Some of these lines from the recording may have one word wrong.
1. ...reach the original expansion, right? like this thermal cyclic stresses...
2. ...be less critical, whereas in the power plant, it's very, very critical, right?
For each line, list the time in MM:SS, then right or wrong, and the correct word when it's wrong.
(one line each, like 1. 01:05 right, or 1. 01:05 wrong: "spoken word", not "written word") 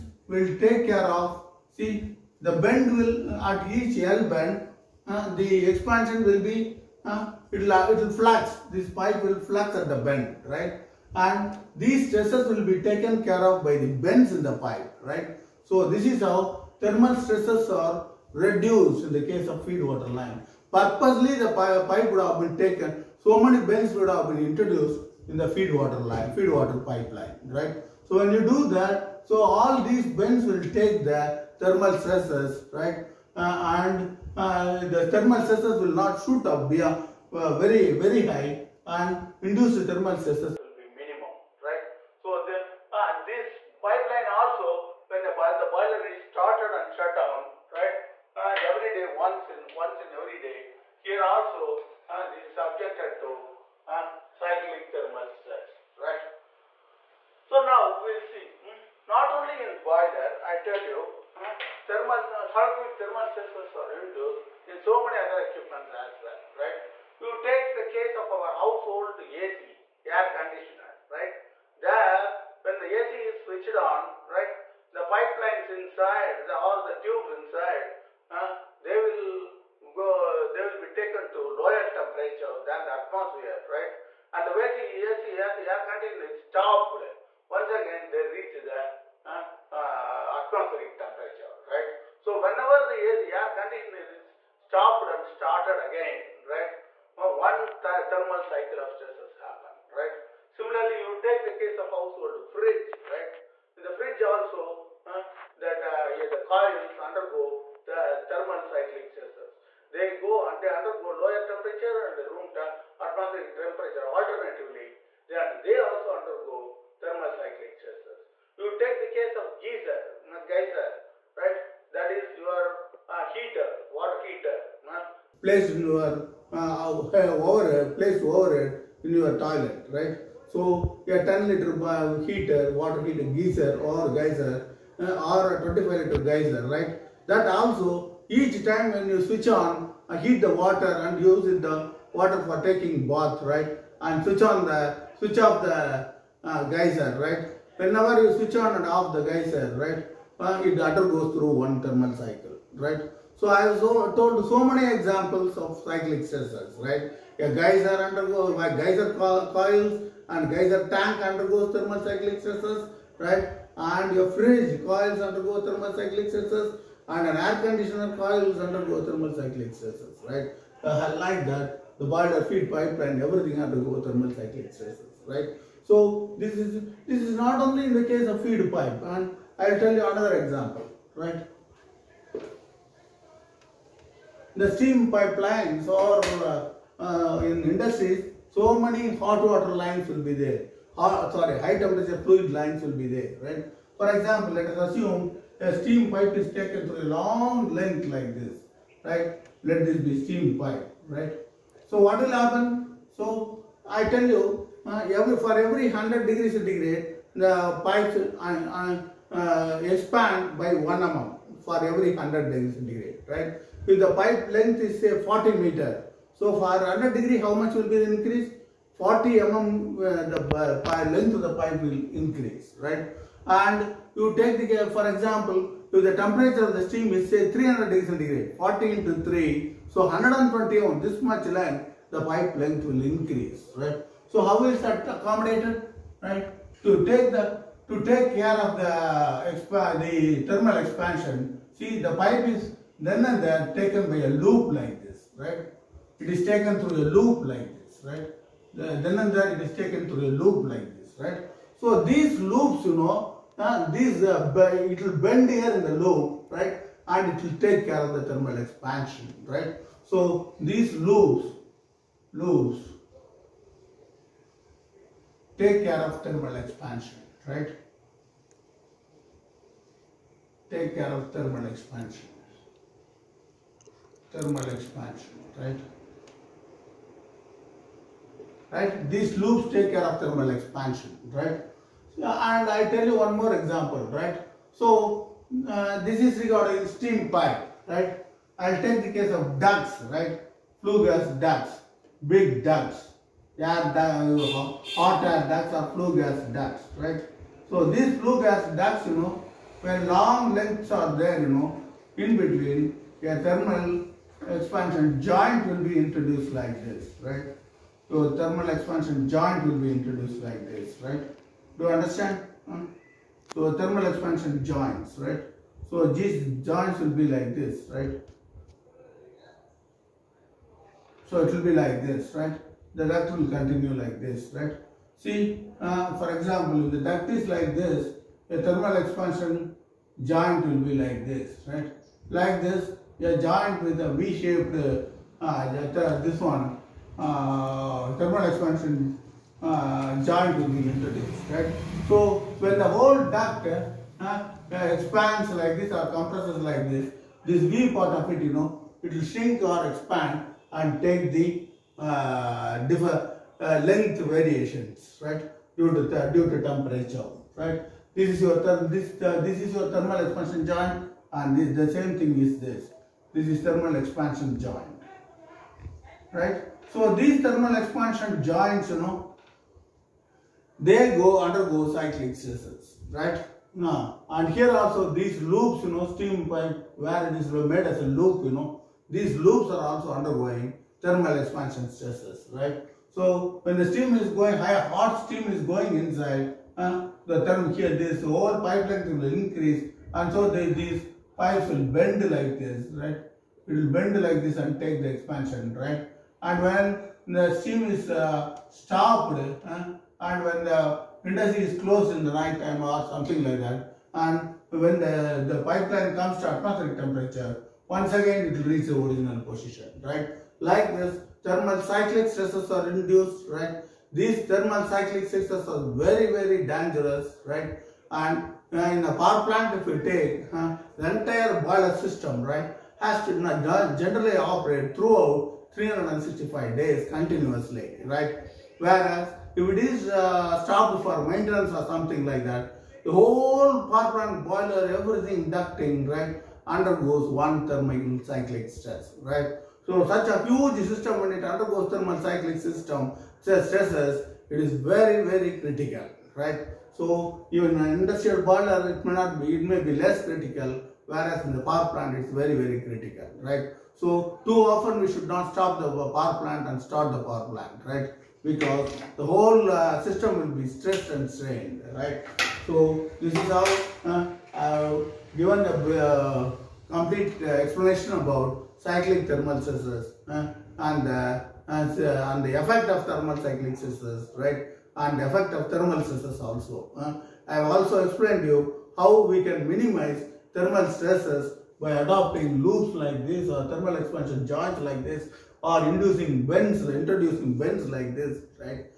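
1. 06:48 wrong: "position", not "expansion"
2. 07:29 right.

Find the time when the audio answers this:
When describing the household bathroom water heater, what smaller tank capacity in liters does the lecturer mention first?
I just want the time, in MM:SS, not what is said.
02:11.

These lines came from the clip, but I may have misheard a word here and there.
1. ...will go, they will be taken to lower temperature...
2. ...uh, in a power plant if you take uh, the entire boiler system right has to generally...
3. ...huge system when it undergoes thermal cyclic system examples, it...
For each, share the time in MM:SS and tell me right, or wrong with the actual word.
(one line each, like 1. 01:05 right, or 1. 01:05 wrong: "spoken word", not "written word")
1. 01:18 right
2. 06:58 right
3. 07:20 wrong: "stresses", not "examples".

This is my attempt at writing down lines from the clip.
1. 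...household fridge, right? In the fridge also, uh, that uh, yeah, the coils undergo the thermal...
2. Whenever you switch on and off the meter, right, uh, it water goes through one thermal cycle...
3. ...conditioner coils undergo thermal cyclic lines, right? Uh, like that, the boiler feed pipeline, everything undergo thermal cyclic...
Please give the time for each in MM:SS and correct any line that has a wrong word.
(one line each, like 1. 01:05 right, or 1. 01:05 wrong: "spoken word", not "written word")
1. 01:41 right
2. 02:27 wrong: "geyser", not "meter"
3. 02:47 wrong: "stresses", not "lines".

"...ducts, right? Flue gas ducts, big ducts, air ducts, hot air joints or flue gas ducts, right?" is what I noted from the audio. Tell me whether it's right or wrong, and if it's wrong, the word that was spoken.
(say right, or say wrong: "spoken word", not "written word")
wrong: "ducts", not "joints".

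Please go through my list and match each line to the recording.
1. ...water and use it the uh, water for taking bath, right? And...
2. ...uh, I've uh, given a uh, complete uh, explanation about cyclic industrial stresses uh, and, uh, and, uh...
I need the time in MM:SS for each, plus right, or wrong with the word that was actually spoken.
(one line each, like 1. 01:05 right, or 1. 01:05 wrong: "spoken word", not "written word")
1. 02:20 right
2. 07:44 wrong: "thermal", not "industrial".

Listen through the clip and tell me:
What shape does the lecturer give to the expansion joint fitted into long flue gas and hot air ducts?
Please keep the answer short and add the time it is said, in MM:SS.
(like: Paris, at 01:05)
V-shaped, at 05:34.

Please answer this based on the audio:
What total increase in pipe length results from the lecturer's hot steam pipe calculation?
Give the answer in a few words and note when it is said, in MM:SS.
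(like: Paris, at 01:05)
120 mm, at 03:50.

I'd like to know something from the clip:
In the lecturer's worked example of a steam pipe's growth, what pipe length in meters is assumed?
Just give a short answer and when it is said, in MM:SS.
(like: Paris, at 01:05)
40 meter, at 03:35.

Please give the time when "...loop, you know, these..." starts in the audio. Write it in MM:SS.
06:18.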